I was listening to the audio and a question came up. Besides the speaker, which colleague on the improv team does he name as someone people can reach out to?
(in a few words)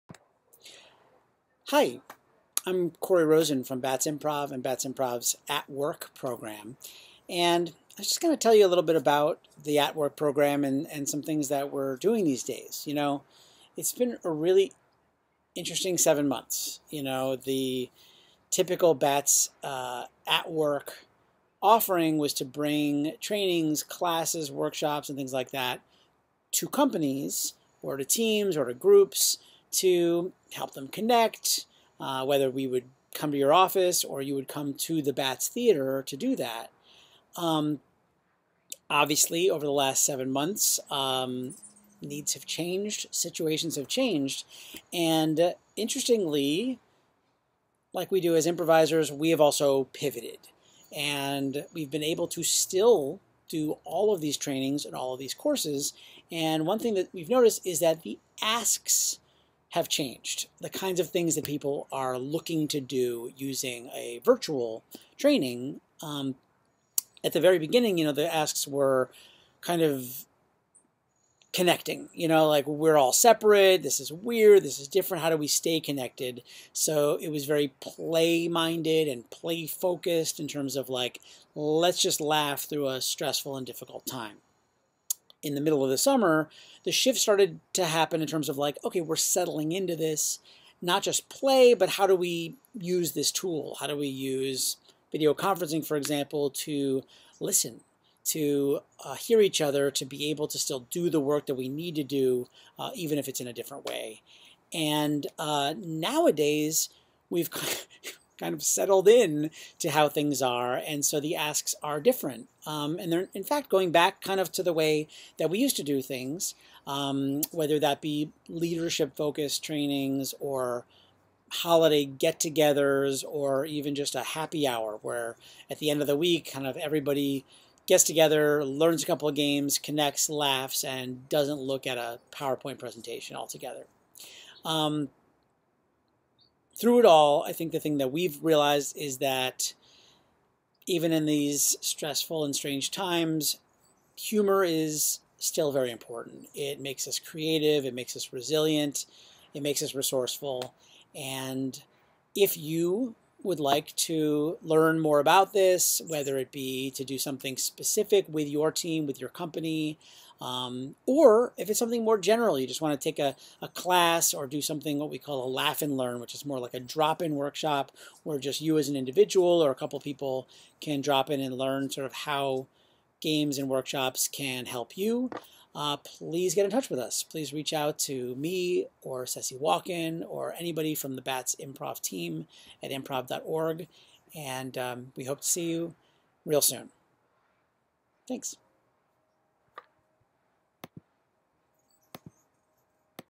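Ceci Walken.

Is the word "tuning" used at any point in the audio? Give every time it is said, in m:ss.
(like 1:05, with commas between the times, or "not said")
not said.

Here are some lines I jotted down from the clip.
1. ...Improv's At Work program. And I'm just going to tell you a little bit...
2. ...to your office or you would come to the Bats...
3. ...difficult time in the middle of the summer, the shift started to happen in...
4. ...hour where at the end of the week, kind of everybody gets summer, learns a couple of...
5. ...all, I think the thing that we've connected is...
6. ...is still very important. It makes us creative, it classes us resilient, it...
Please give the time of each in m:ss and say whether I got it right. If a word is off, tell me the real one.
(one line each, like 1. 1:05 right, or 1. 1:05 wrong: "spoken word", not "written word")
1. 0:04 right
2. 0:33 right
3. 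1:23 right
4. 2:04 wrong: "together", not "summer"
5. 2:17 wrong: "realized", not "connected"
6. 2:24 wrong: "makes", not "classes".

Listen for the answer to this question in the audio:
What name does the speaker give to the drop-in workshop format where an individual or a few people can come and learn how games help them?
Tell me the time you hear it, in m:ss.
2:45.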